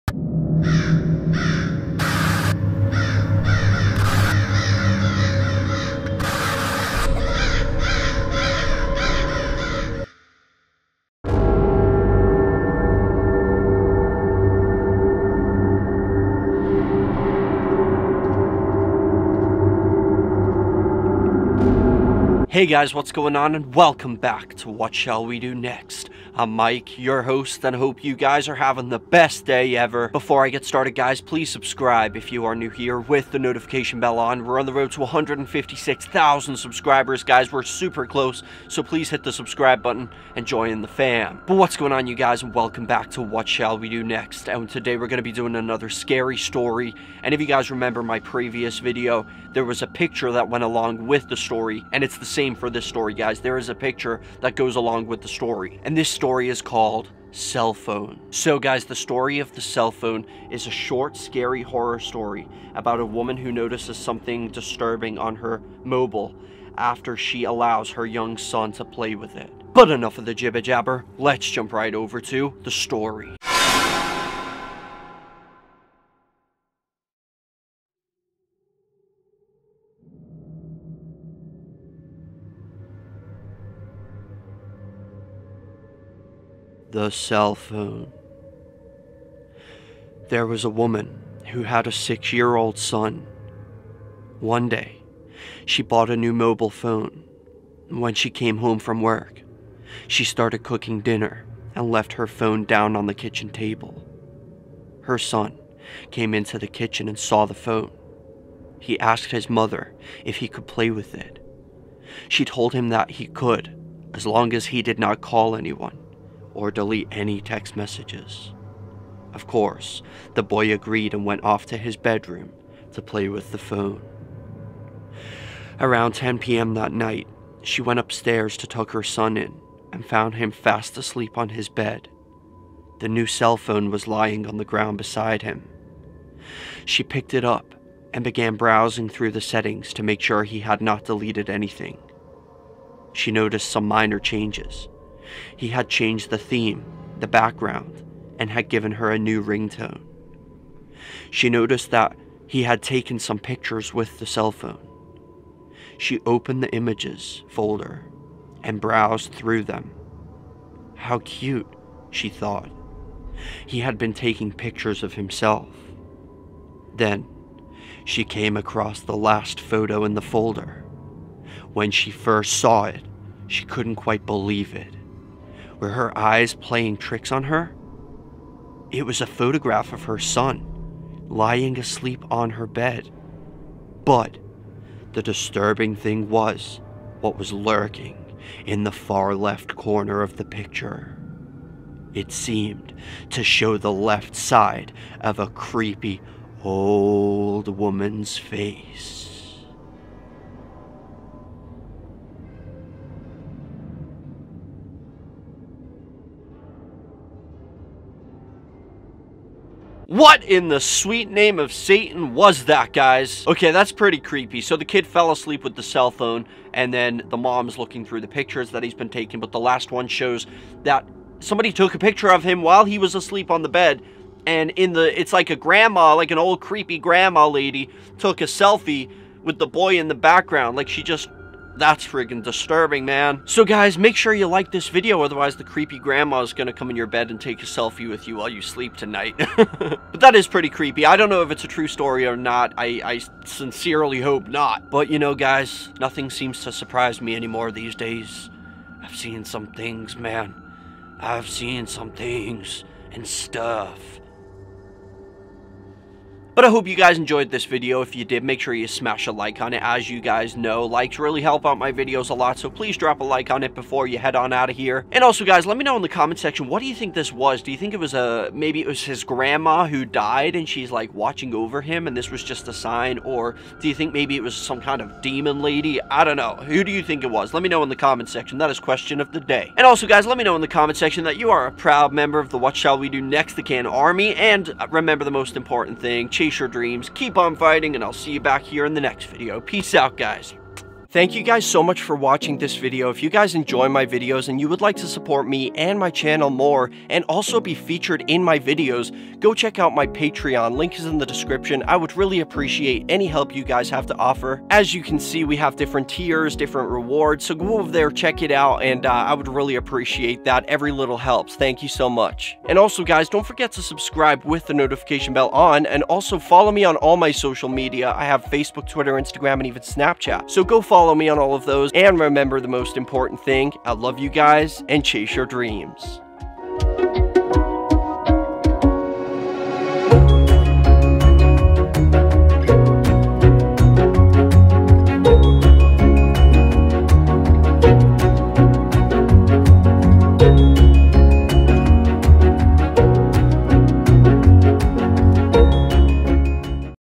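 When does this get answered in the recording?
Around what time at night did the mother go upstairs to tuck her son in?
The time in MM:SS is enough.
02:06.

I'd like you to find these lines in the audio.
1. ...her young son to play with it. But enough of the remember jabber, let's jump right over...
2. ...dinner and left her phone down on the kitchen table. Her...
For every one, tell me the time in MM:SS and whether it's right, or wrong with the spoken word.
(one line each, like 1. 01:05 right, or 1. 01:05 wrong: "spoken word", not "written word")
1. 01:07 wrong: "jibber", not "remember"
2. 01:41 right.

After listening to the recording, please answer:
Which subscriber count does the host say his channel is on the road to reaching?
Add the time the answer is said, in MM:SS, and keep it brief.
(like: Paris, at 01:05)
156,000, at 00:35.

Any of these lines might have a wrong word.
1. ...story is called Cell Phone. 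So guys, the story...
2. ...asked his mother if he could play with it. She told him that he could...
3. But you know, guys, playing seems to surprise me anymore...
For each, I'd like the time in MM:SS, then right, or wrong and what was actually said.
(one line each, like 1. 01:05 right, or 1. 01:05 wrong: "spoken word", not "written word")
1. 00:56 right
2. 01:48 right
3. 04:04 wrong: "nothing", not "playing".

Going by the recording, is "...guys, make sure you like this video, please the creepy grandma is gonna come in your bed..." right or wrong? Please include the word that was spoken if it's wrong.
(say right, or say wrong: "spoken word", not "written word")
wrong: "otherwise", not "please".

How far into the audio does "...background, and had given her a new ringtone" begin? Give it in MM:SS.
02:27.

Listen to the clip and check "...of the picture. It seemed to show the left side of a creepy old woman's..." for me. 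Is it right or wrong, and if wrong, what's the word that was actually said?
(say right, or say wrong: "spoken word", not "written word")
right.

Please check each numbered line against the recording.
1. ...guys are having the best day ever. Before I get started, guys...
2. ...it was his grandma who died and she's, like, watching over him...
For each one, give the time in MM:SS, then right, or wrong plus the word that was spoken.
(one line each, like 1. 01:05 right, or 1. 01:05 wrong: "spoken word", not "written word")
1. 00:28 right
2. 04:28 right.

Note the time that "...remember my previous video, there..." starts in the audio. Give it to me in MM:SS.
00:47.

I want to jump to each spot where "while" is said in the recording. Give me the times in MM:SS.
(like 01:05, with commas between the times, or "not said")
03:42, 03:58.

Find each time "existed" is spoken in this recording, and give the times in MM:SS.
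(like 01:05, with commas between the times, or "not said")
not said.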